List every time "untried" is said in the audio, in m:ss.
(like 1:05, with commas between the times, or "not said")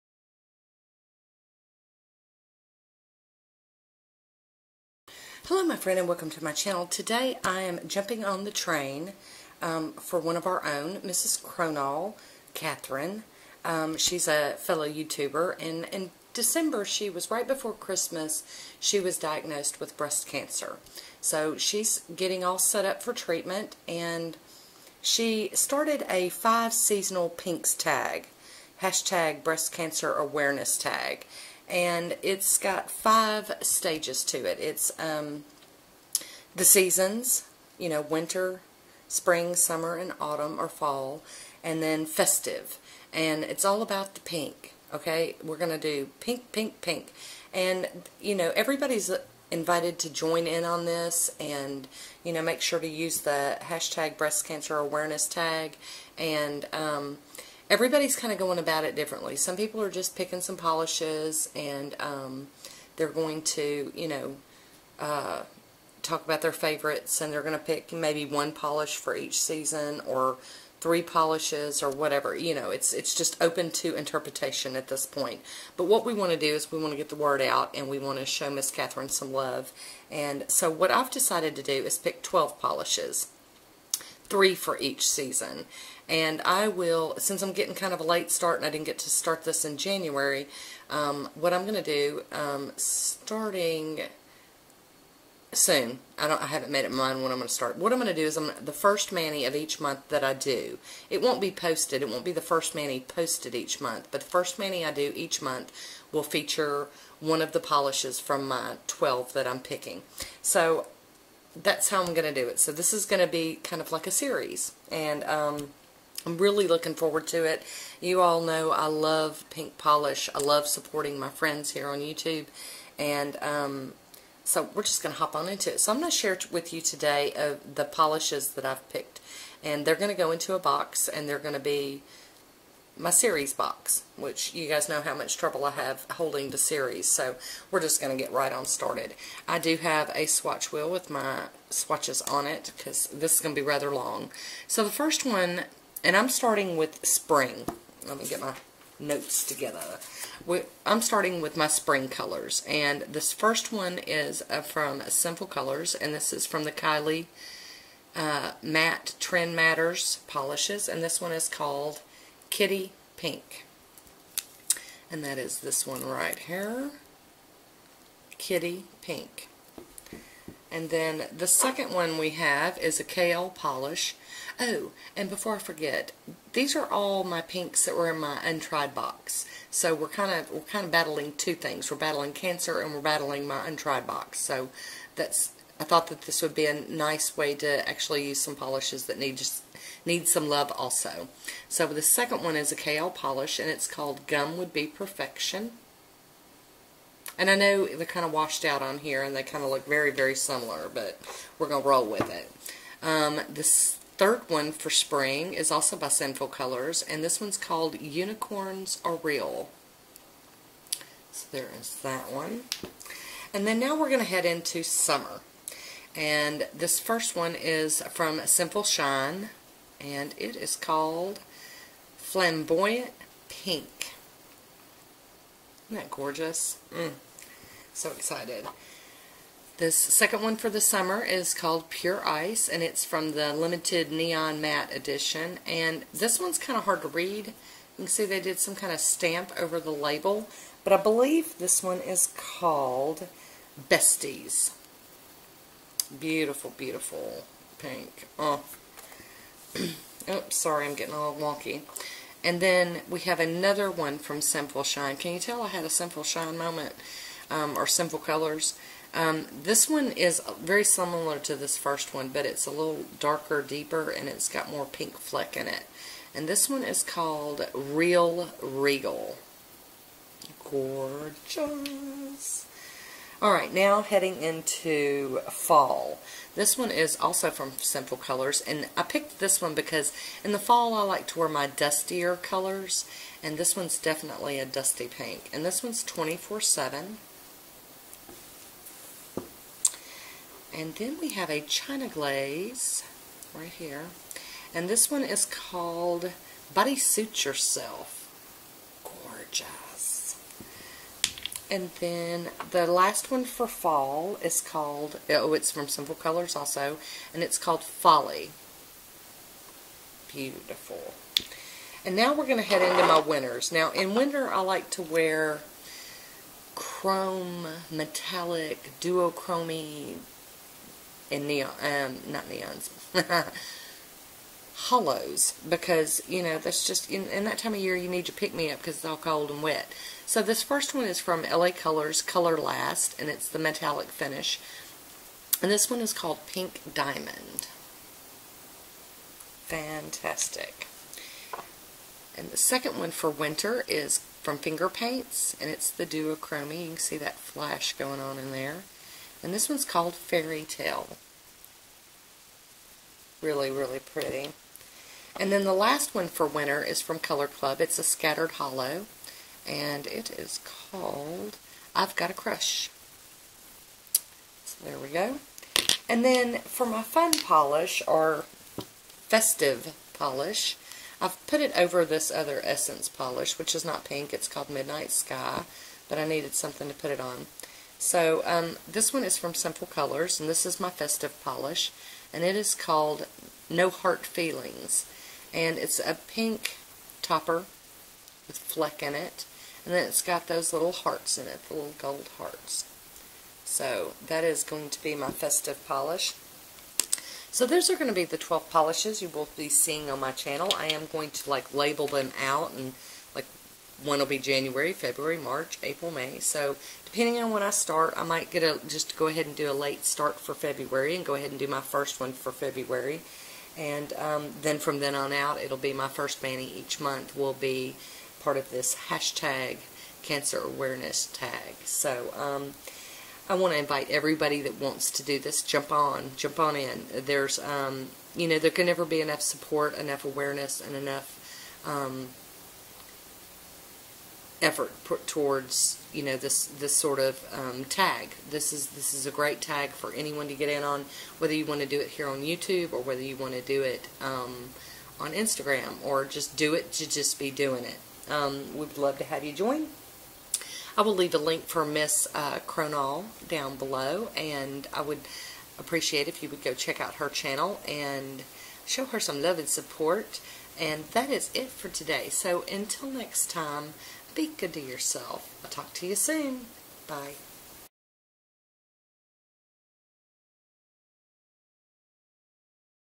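2:58, 3:03.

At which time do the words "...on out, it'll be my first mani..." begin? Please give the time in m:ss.
6:55.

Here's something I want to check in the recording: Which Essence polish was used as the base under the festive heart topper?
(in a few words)
Midnight Sky.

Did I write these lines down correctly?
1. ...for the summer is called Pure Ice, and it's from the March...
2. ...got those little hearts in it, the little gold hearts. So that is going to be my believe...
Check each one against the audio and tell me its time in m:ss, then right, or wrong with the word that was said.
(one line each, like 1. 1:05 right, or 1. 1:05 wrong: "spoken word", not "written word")
1. 3:50 wrong: "Limited", not "March"
2. 6:30 wrong: "festive", not "believe".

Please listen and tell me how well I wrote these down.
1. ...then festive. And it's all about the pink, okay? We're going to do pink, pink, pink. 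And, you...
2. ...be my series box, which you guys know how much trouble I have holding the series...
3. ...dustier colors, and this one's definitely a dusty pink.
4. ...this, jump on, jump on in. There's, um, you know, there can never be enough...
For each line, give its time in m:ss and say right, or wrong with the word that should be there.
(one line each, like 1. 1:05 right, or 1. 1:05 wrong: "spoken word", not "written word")
1. 0:41 right
2. 2:11 right
3. 4:41 right
4. 7:05 right.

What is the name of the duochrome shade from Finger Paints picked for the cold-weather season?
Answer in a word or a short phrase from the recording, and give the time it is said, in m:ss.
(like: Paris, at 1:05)
Fairy Tale, at 5:50.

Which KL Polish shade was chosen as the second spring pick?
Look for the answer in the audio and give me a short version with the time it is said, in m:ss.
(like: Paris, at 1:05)
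Gum Would Be Perfection, at 3:14.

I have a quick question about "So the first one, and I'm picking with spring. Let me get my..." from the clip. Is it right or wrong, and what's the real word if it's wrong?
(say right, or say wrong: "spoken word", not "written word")
wrong: "starting", not "picking".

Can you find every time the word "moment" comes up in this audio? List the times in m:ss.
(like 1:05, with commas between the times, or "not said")
4:16.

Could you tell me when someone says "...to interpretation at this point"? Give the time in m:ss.
1:13.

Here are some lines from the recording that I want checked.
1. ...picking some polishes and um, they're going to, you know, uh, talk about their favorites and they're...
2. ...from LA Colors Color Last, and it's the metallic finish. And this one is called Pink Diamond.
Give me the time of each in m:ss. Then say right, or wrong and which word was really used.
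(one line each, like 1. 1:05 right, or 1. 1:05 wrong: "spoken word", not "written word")
1. 1:00 right
2. 5:31 right.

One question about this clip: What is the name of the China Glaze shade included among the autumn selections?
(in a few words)
Buddy Suit Yourself.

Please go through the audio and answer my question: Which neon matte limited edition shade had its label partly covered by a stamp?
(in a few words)
Besties.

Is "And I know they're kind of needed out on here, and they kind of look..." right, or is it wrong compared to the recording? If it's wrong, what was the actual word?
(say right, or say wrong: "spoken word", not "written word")
wrong: "washed", not "needed".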